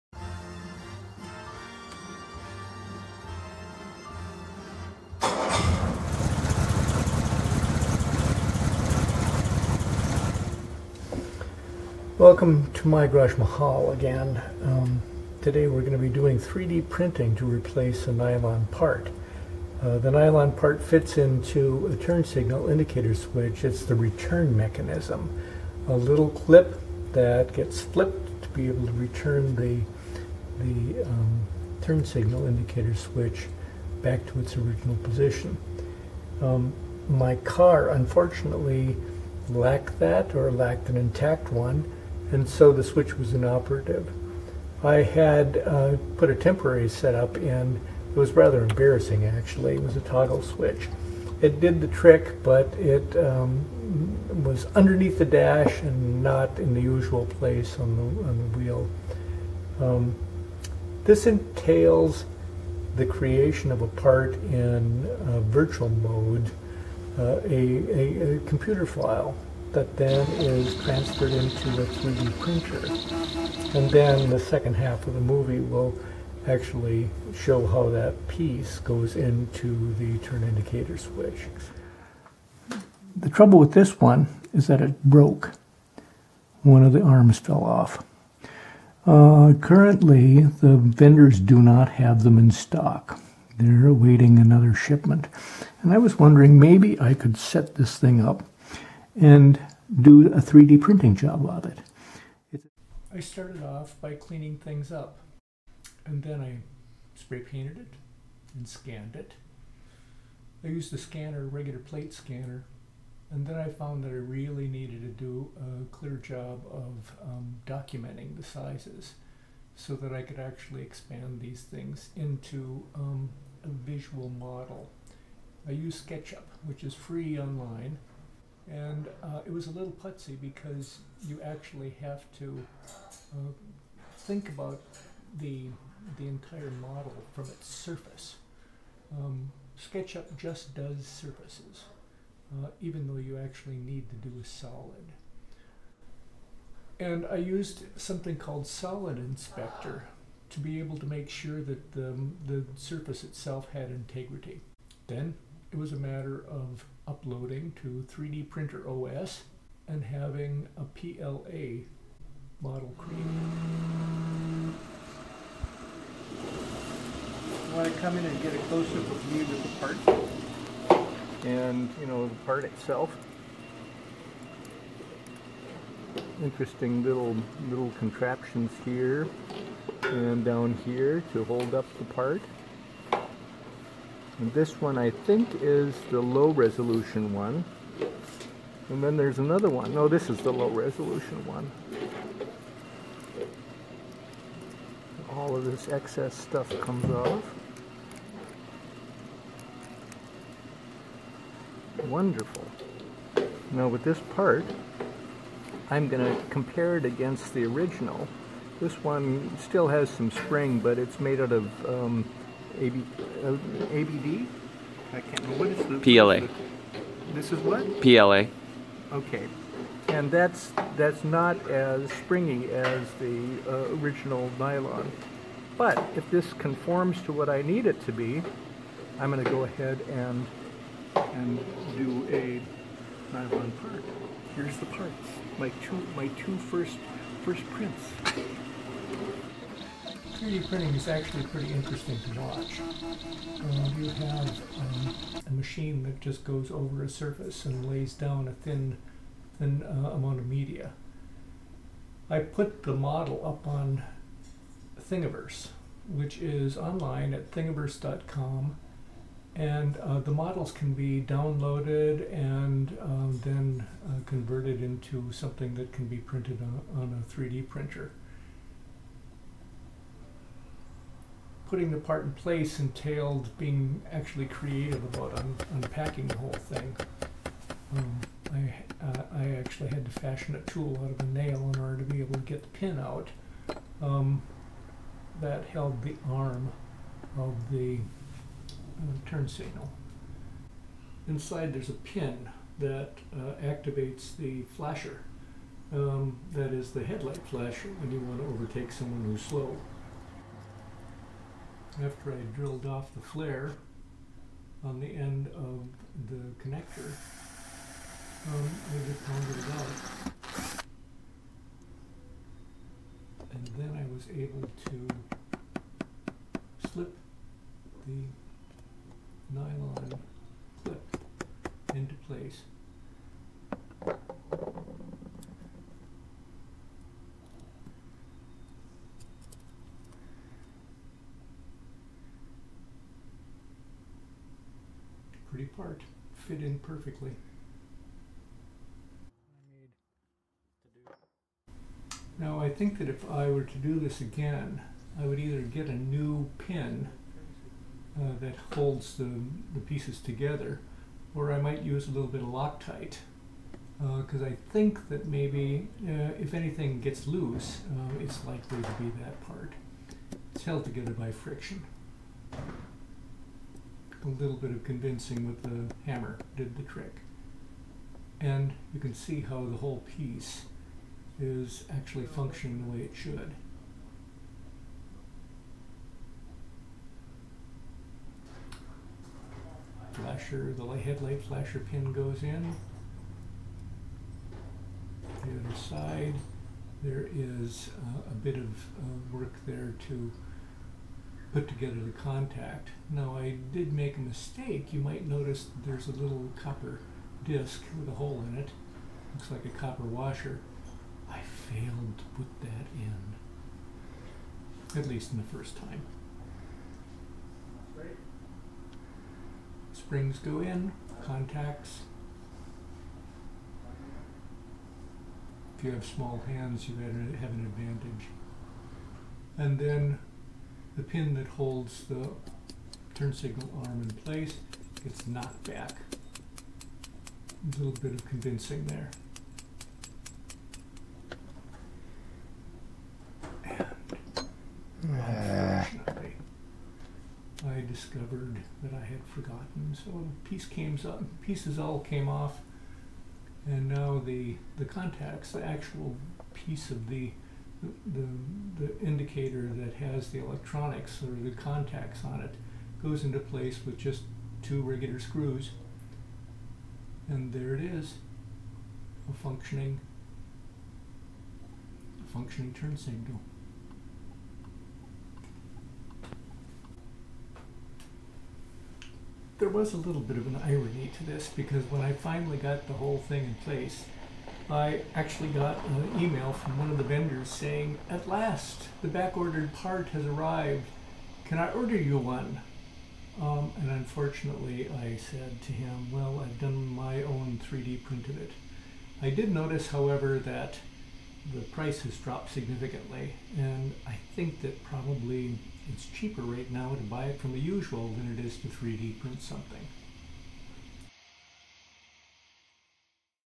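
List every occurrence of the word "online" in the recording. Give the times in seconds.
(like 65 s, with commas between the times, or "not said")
127 s, 256 s.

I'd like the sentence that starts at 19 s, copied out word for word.
Uh, the nylon part fits into a turn signal indicator switch.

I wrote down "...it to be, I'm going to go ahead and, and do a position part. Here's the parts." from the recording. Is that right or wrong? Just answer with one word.
wrong.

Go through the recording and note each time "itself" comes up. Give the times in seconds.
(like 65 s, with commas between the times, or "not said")
153 s, 172 s.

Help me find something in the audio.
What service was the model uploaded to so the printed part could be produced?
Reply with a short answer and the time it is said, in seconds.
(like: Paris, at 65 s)
3D Printer OS, at 158 s.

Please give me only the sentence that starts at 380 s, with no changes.
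Flasher, the headlight flasher pin goes in.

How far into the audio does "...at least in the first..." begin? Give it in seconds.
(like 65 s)
405 s.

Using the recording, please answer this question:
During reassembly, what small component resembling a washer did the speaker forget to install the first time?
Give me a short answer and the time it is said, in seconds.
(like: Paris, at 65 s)
Copper disc, at 396 s.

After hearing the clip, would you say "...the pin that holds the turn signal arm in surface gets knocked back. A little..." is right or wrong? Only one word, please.
wrong.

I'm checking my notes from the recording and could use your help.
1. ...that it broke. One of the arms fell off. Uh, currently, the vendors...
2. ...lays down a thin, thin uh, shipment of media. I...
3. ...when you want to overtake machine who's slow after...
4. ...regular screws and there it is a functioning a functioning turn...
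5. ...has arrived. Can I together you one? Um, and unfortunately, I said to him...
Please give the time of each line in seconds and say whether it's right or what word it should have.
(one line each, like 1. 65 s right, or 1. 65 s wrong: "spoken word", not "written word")
1. 84 s right
2. 247 s wrong: "amount", not "shipment"
3. 298 s wrong: "someone", not "machine"
4. 454 s right
5. 480 s wrong: "order", not "together".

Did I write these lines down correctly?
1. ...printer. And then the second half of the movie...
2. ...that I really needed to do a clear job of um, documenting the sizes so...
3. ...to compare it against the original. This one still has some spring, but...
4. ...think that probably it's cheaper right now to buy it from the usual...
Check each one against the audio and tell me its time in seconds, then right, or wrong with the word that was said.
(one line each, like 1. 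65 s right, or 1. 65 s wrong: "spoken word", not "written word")
1. 72 s right
2. 114 s right
3. 206 s right
4. 494 s right.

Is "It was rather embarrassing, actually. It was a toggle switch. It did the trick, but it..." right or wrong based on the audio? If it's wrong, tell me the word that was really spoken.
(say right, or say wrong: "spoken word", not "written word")
right.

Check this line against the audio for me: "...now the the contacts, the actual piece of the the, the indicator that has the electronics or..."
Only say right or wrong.
right.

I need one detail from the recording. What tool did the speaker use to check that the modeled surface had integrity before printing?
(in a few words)
Solid Inspector.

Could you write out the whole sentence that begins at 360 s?
It's held together by friction a little bit of convincing with the hammer did the trick.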